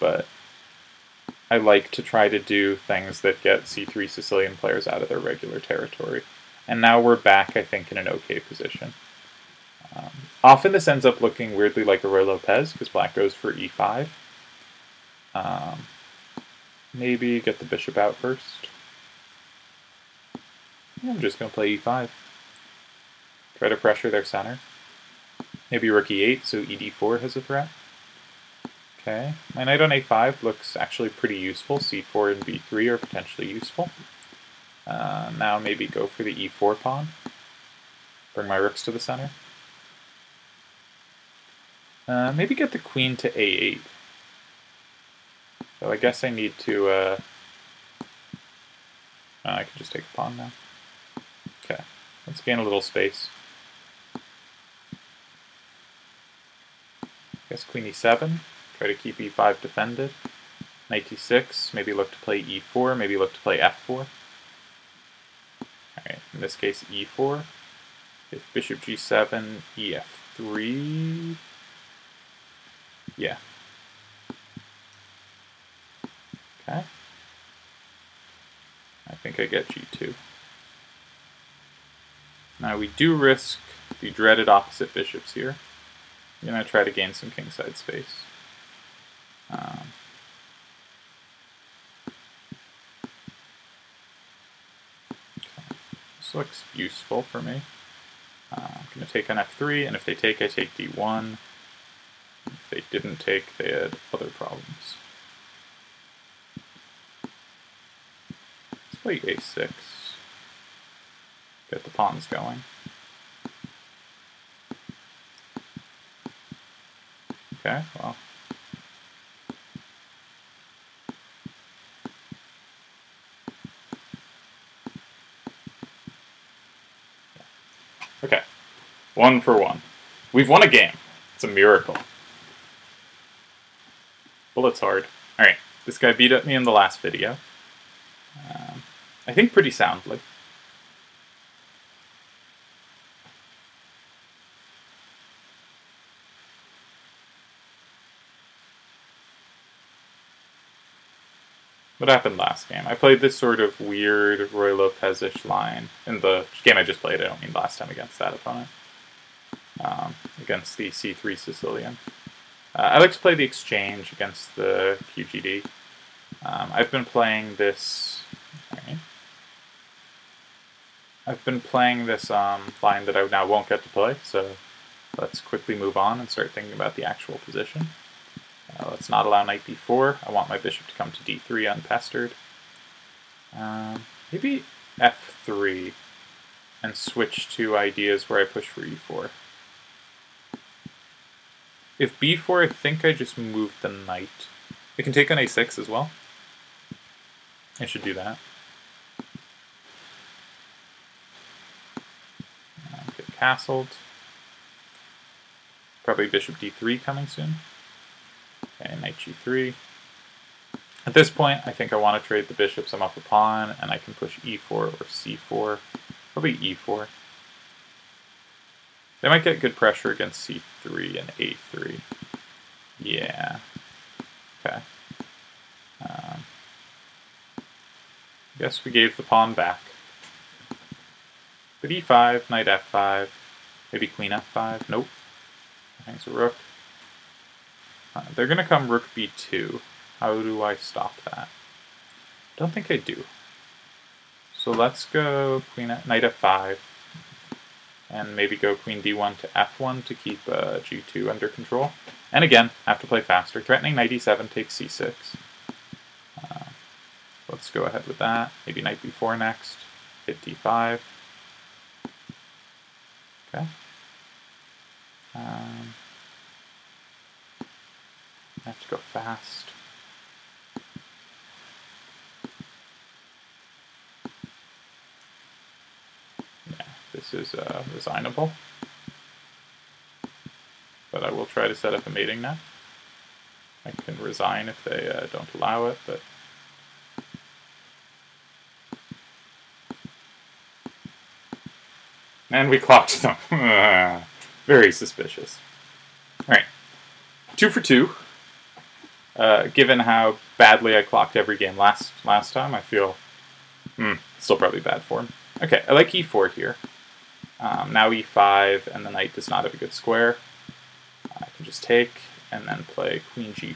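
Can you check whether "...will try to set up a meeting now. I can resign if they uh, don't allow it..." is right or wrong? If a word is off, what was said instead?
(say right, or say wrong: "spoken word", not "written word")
right.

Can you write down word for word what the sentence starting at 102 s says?
If they didn't take, they had other problems.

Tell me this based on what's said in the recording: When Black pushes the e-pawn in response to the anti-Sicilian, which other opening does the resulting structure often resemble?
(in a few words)
Ruy Lopez.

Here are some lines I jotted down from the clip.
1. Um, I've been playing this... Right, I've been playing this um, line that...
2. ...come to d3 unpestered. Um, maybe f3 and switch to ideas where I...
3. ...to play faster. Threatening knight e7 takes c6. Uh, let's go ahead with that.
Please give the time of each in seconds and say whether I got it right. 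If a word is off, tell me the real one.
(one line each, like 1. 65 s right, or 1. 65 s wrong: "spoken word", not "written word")
1. 166 s right
2. 180 s right
3. 252 s right.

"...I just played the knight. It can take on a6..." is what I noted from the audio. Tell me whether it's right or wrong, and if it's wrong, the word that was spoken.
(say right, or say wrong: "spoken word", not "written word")
wrong: "moved", not "played".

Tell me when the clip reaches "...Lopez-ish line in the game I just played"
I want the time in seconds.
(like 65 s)
154 s.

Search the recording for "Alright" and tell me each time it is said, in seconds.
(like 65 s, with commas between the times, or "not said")
65 s, 135 s.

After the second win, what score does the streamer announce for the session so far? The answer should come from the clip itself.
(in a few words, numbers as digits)
two for two.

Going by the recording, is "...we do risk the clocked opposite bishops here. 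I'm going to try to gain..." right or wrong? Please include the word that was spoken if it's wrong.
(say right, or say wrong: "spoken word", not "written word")
wrong: "dreaded", not "clocked".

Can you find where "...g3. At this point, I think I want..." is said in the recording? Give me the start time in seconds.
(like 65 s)
209 s.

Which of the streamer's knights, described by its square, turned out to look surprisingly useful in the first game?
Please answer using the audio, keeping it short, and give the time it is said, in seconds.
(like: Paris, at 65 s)
knight on a5, at 29 s.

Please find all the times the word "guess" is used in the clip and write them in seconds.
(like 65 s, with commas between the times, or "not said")
45 s, 57 s, 228 s.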